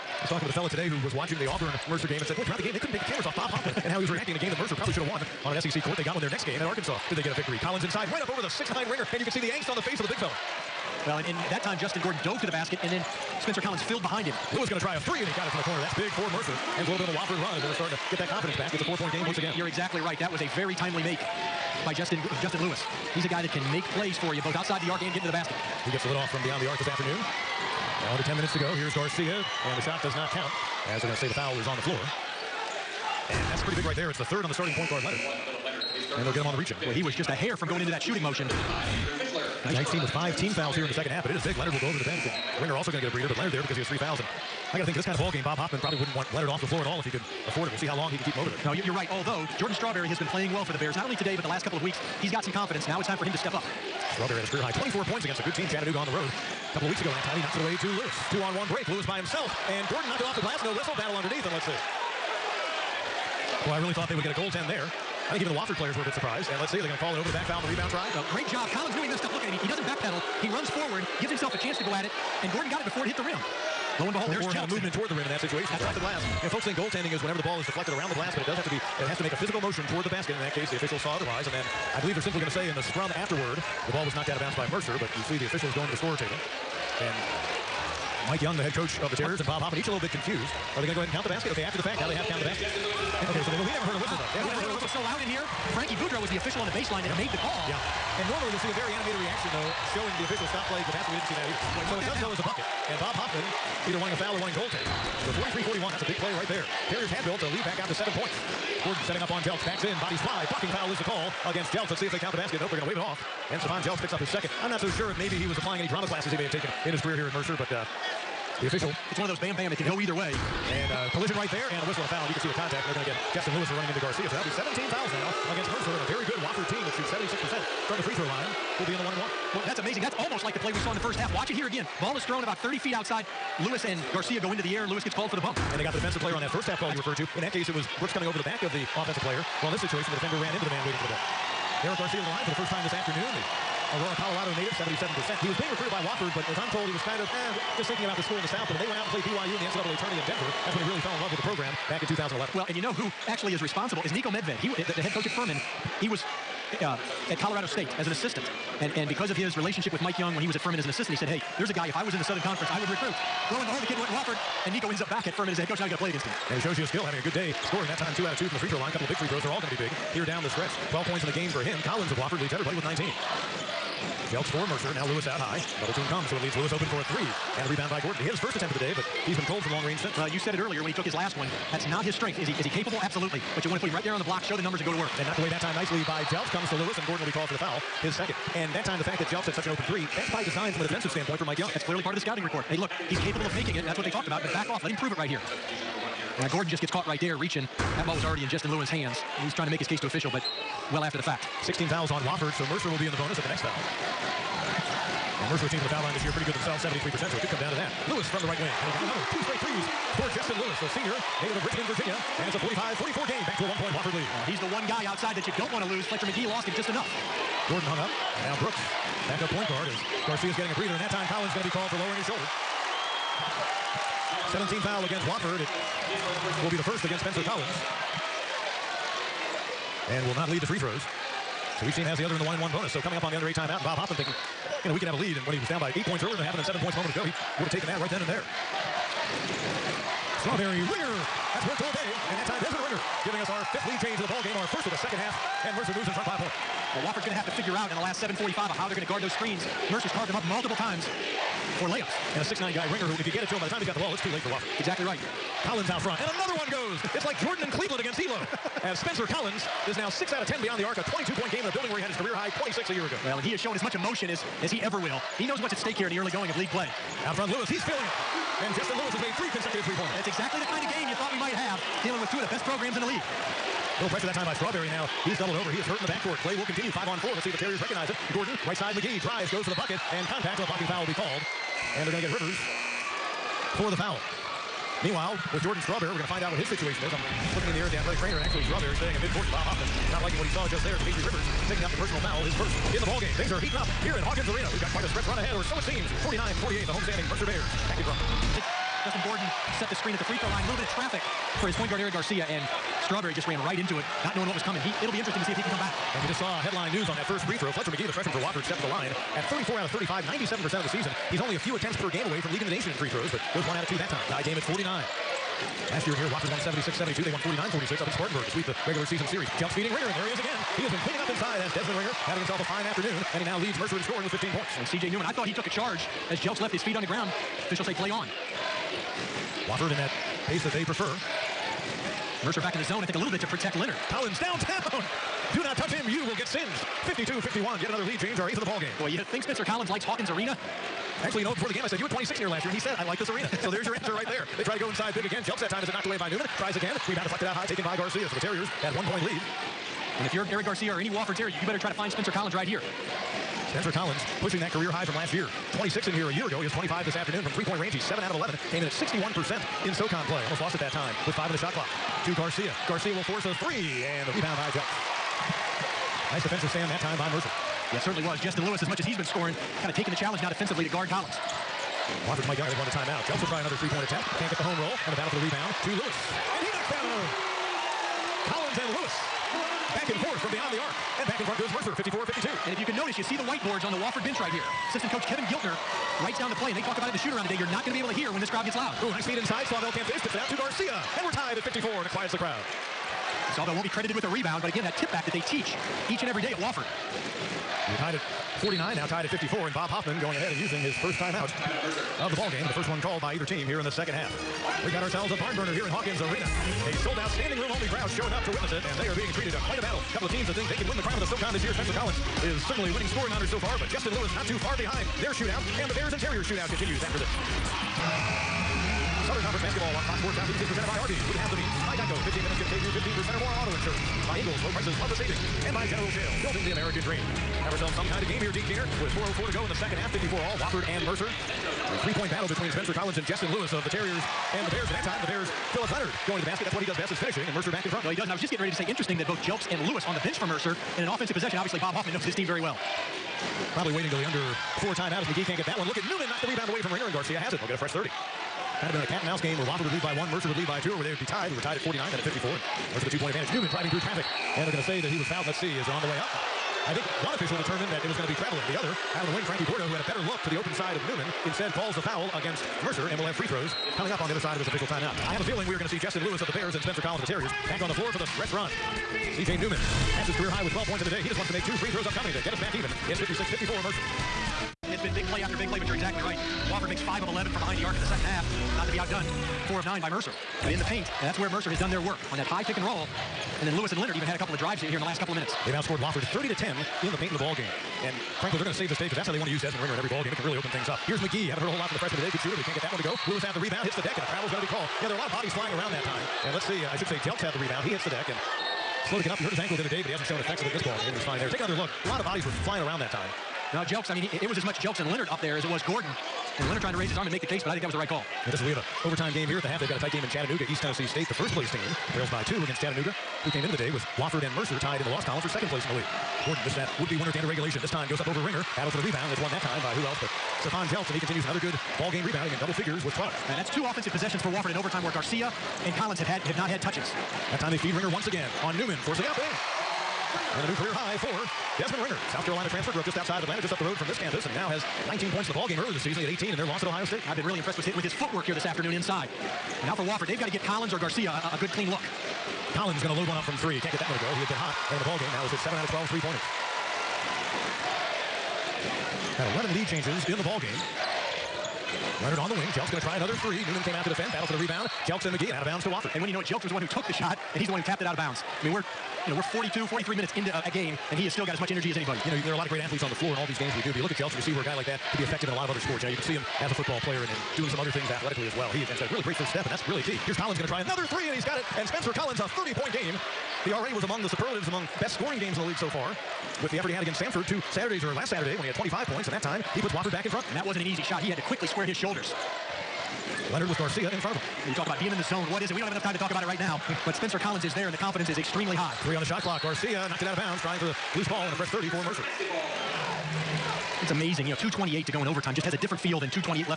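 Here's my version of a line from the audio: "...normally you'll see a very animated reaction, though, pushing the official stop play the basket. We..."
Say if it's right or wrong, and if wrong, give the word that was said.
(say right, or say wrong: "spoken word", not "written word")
wrong: "showing", not "pushing".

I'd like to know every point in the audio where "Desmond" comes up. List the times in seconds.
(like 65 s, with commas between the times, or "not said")
321 s, 489 s, 531 s.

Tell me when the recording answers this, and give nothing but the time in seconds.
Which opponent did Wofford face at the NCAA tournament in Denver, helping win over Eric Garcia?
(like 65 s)
149 s.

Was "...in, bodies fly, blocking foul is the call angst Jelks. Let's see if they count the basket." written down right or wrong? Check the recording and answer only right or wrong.
wrong.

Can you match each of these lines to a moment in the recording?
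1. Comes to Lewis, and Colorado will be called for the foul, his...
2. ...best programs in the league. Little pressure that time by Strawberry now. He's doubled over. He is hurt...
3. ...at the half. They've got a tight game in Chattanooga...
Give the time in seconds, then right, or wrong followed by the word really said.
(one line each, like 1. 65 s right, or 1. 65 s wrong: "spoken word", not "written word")
1. 186 s wrong: "Gordon", not "Colorado"
2. 272 s right
3. 509 s right.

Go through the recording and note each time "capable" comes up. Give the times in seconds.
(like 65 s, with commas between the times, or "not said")
182 s, 193 s.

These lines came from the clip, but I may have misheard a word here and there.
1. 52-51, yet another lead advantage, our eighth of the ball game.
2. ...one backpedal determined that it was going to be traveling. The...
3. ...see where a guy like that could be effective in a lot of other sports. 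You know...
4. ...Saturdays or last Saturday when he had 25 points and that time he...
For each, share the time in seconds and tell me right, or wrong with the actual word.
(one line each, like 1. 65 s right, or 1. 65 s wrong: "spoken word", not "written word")
1. 337 s wrong: "change", not "advantage"
2. 457 s wrong: "official", not "backpedal"
3. 564 s right
4. 577 s right.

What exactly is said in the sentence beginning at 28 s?
Now under 10 minutes to go.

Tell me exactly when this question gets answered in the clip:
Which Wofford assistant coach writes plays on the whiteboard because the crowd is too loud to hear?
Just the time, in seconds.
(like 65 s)
385 s.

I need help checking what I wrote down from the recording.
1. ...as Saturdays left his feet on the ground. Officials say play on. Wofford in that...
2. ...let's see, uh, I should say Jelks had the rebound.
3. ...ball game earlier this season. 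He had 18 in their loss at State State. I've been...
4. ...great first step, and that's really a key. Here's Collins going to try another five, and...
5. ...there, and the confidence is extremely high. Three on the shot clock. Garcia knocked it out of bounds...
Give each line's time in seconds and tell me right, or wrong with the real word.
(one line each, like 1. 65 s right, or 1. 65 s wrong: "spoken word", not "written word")
1. 326 s wrong: "Jelks", not "Saturdays"
2. 496 s right
3. 535 s wrong: "Ohio", not "State"
4. 569 s wrong: "three", not "five"
5. 587 s right.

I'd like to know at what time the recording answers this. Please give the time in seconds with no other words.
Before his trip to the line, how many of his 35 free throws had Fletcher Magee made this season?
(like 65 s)
309 s.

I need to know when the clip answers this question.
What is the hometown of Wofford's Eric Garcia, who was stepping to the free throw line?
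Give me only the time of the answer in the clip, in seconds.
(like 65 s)
143 s.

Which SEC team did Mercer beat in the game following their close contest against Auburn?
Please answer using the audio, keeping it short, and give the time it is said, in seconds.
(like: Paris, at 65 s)
Arkansas, at 6 s.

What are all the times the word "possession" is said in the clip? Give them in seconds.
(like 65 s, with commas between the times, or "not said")
441 s, 524 s.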